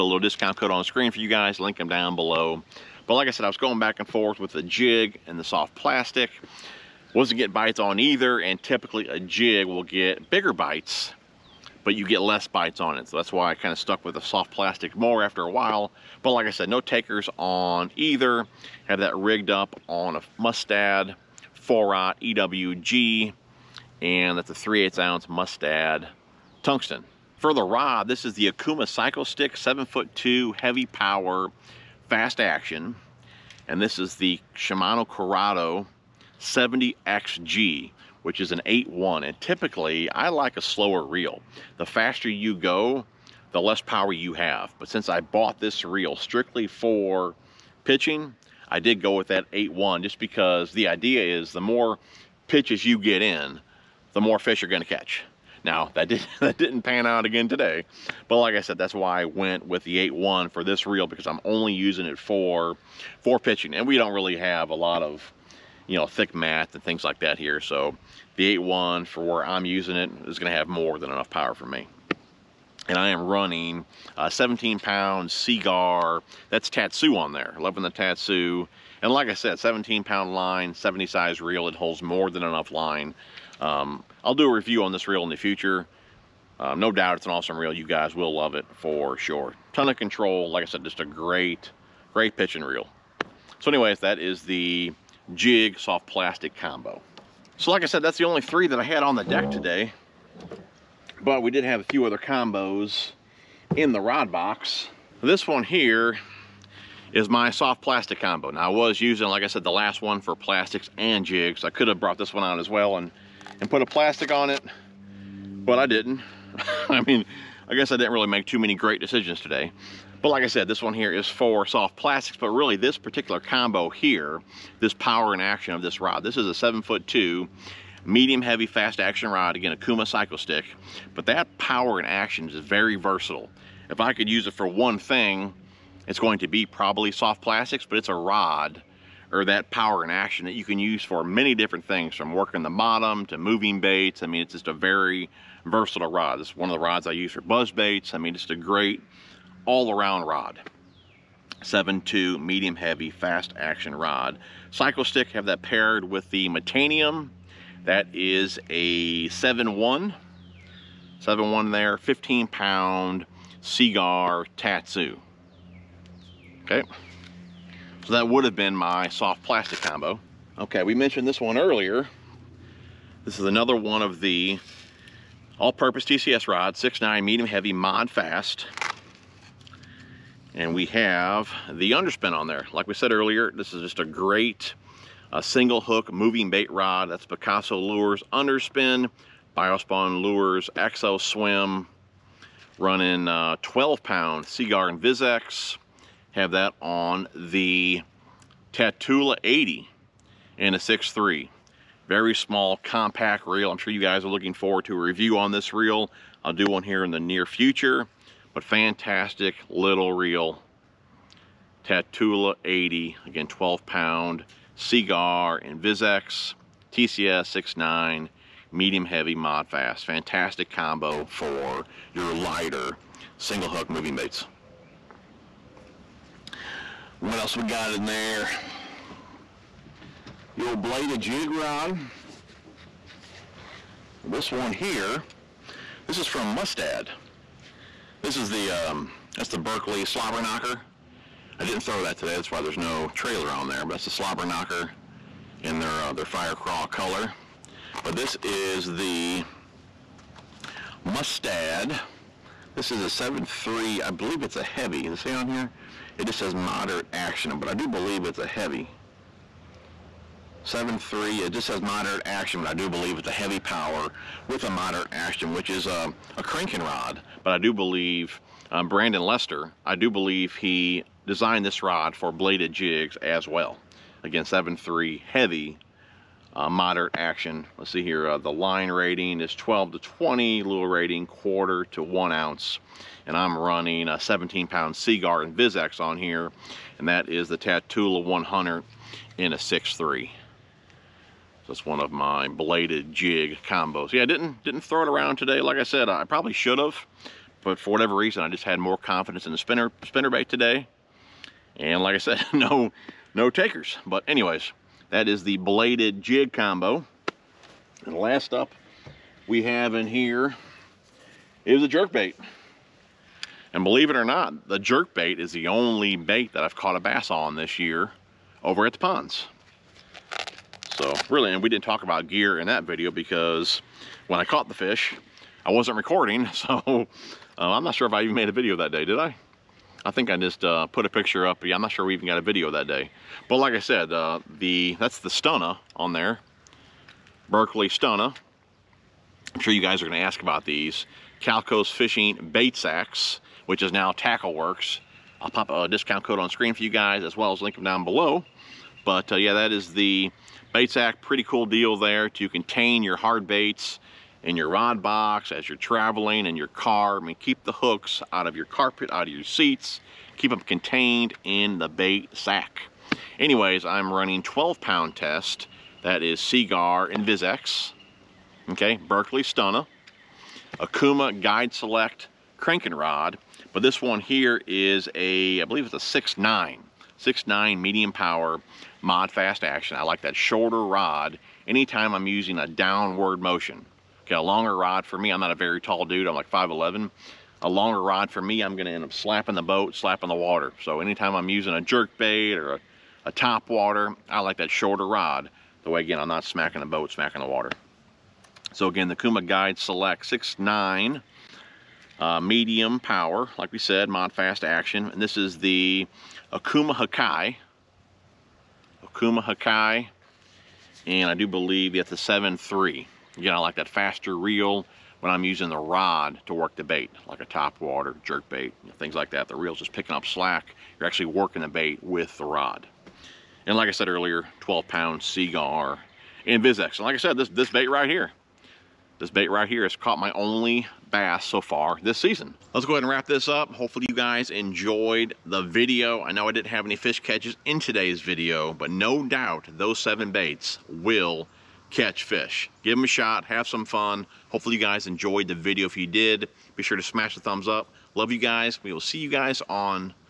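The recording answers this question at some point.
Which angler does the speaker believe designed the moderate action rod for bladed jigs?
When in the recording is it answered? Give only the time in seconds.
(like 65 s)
268 s.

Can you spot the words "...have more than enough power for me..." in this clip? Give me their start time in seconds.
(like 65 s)
70 s.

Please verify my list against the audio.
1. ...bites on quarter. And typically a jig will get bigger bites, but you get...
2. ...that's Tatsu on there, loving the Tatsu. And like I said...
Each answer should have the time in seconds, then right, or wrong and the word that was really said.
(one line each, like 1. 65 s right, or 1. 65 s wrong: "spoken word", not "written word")
1. 7 s wrong: "either", not "quarter"
2. 76 s right.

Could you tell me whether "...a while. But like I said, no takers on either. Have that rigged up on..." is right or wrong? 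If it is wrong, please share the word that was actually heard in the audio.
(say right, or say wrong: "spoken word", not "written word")
right.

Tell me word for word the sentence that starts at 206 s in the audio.
I'll do one here in the near future, but fantastic little reel.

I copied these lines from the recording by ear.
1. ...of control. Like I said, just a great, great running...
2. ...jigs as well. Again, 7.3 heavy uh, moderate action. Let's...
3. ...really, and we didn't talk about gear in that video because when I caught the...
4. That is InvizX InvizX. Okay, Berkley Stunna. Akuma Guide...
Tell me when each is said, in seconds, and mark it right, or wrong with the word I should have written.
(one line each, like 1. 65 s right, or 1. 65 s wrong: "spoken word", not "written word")
1. 89 s wrong: "pitching", not "running"
2. 272 s right
3. 321 s right
4. 366 s wrong: "Seaguar", not "InvizX".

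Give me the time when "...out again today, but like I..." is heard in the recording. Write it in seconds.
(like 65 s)
57 s.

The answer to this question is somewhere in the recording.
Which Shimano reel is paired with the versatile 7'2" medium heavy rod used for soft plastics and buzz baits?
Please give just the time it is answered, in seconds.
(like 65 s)
156 s.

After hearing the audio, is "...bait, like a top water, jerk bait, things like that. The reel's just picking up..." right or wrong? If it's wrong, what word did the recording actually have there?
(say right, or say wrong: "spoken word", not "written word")
right.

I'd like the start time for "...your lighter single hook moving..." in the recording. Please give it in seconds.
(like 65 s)
222 s.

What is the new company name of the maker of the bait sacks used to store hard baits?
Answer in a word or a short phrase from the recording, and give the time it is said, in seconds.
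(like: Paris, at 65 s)
TackleWorkz, at 344 s.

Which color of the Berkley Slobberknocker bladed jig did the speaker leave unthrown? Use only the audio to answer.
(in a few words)
fire crawl.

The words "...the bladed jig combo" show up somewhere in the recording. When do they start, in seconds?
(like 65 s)
305 s.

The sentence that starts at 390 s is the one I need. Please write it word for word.
So anytime I'm using a jerk bait or a, a top water, I like that shorter rod.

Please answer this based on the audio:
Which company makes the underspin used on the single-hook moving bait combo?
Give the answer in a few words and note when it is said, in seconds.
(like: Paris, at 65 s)
Picasso Lures, at 187 s.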